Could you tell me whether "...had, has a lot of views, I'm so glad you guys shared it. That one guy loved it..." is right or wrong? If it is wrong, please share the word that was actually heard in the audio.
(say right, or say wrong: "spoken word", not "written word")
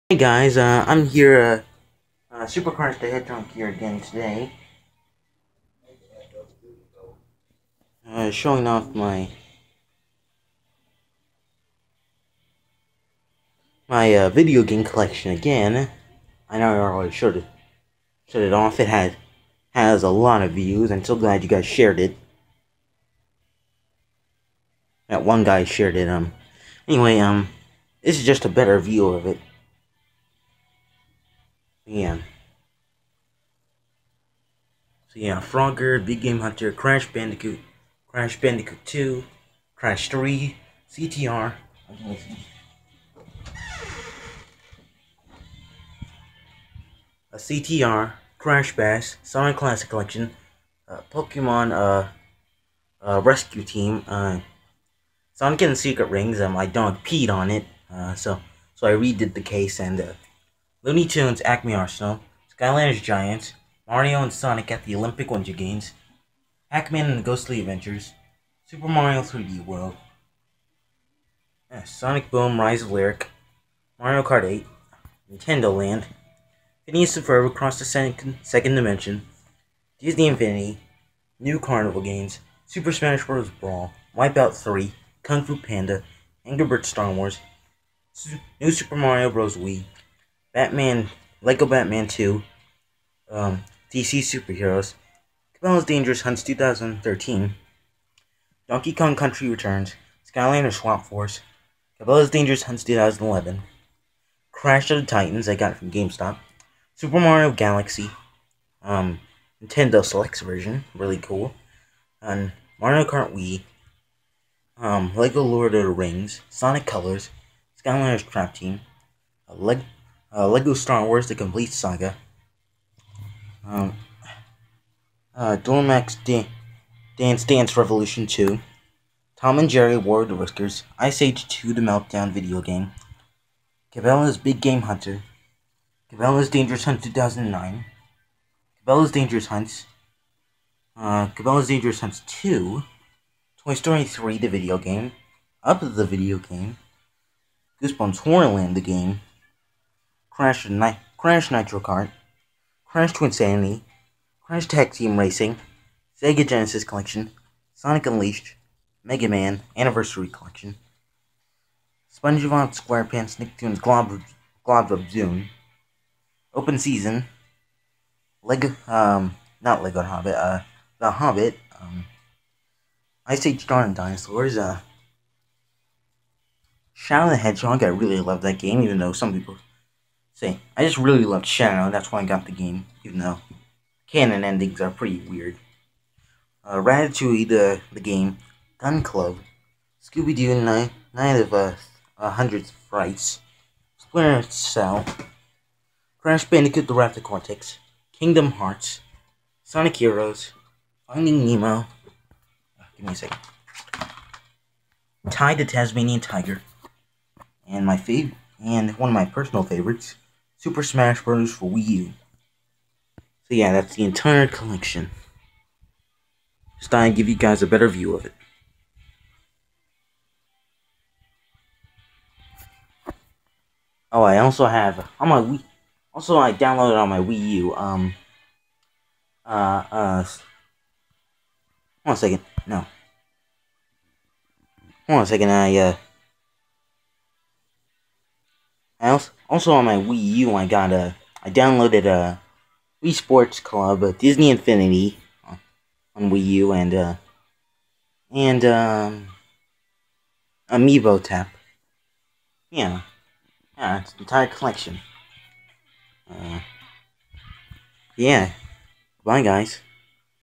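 wrong: "shared", not "loved".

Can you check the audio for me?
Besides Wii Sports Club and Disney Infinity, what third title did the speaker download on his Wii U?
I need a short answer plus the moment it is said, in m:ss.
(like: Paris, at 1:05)
Amiibo Tap, at 4:10.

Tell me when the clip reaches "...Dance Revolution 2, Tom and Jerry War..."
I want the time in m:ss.
2:07.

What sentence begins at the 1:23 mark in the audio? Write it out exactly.
Brawl, Wipeout 3, Kung Fu Panda, Angry Birds Star Wars, New Super Mario Bros.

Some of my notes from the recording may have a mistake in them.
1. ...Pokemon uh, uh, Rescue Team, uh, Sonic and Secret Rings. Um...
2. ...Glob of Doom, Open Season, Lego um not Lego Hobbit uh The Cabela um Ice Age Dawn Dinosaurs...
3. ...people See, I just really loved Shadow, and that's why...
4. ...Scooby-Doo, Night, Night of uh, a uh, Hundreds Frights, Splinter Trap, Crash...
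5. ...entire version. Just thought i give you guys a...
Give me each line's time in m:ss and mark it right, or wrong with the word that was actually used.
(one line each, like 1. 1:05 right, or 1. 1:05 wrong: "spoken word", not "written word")
1. 0:51 right
2. 2:44 wrong: "Hobbit", not "Cabela"
3. 2:59 right
4. 3:10 wrong: "Cell", not "Trap"
5. 3:34 wrong: "collection", not "version".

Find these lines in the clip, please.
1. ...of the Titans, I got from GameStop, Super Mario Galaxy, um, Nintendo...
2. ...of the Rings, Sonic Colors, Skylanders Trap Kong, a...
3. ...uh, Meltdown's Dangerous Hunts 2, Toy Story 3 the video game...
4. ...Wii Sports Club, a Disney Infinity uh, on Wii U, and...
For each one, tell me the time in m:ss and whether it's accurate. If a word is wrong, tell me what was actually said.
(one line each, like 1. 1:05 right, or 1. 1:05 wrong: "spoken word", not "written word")
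1. 1:44 right
2. 1:55 wrong: "Team", not "Kong"
3. 2:20 wrong: "Cabela", not "Meltdown"
4. 4:03 right.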